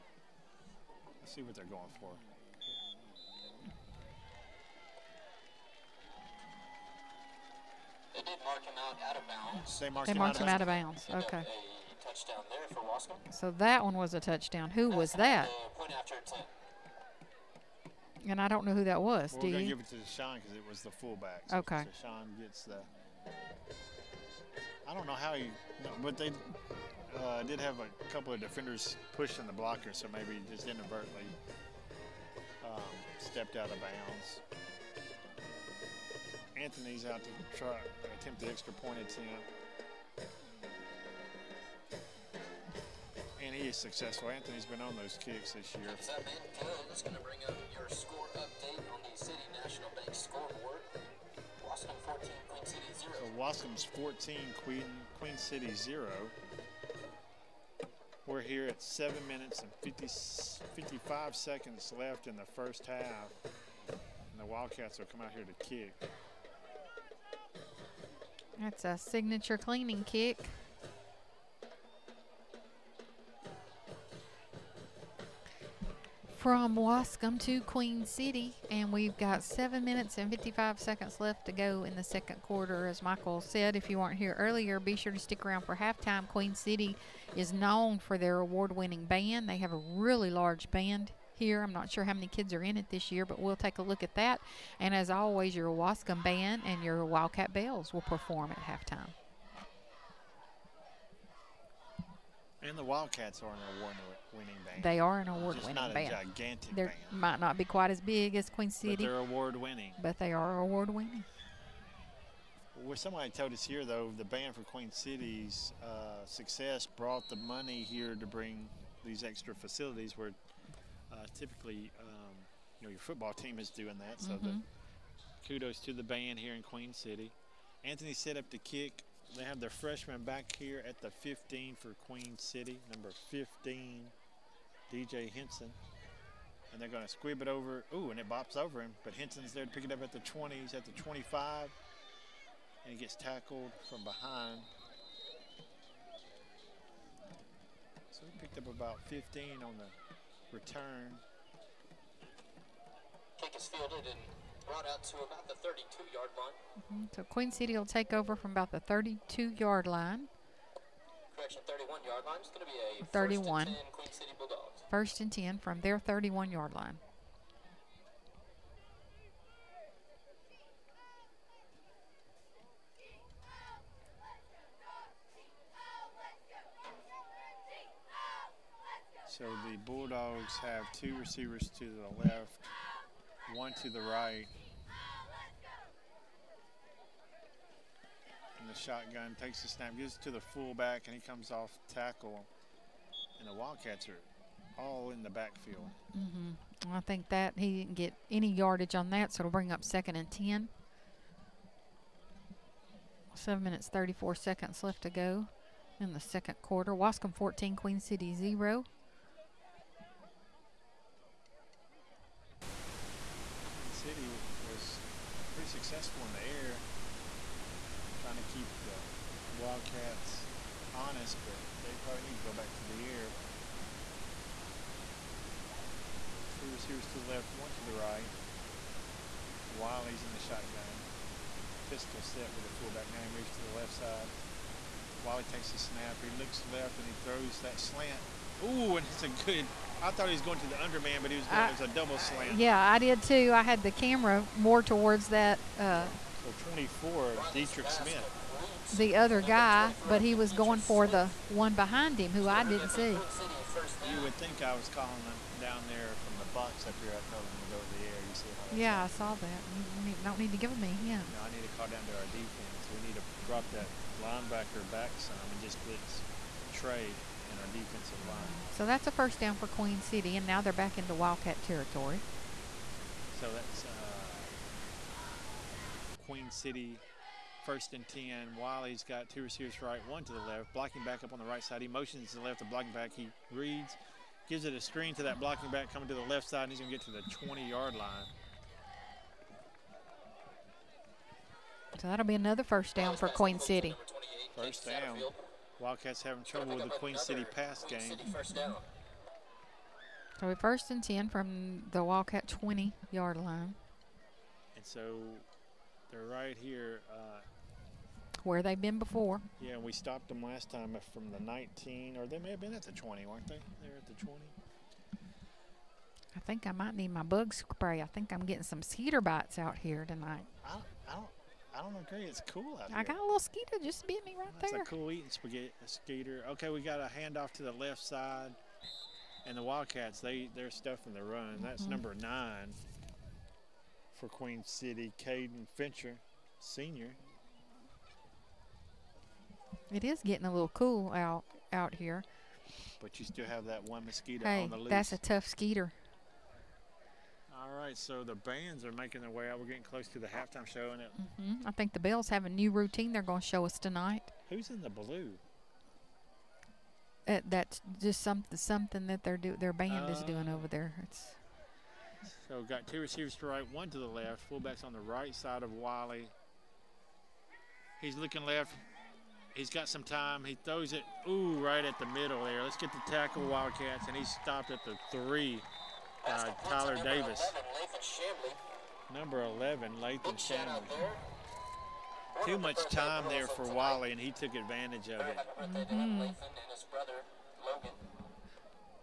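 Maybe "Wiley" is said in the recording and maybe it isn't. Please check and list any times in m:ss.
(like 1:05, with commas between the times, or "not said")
3:49, 3:55, 4:38, 6:05.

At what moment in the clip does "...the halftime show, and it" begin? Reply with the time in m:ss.
5:50.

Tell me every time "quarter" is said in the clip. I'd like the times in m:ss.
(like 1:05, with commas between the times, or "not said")
1:22, 3:26.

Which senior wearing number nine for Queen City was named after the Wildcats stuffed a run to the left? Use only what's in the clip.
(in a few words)
Caden Fincher.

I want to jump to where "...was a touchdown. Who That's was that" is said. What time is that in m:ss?
0:13.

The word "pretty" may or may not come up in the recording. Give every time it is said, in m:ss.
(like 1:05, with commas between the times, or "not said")
3:35.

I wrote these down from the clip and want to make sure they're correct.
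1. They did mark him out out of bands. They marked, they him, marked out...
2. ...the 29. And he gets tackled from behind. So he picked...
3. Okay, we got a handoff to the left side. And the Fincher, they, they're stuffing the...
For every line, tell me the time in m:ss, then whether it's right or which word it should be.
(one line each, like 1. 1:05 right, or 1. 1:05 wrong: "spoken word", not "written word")
1. 0:08 wrong: "bounds", not "bands"
2. 2:20 wrong: "25", not "29"
3. 5:26 wrong: "Wildcats", not "Fincher".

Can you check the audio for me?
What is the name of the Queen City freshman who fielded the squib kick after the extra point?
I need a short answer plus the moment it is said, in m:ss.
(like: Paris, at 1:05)
DJ Henson, at 2:14.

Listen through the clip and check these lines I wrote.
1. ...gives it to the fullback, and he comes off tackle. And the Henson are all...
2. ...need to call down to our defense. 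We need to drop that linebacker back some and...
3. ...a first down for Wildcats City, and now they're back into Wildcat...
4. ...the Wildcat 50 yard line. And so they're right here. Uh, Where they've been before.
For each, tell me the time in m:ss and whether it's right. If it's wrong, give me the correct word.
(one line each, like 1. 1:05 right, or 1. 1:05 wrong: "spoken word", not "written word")
1. 3:09 wrong: "Wildcats", not "Henson"
2. 4:21 right
3. 4:29 wrong: "Queen", not "Wildcats"
4. 5:01 wrong: "20", not "50".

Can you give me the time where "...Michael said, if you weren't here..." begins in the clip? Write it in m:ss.
1:23.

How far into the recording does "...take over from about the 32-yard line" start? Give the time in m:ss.
2:37.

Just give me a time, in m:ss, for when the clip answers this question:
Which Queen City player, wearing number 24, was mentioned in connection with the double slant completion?
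4:07.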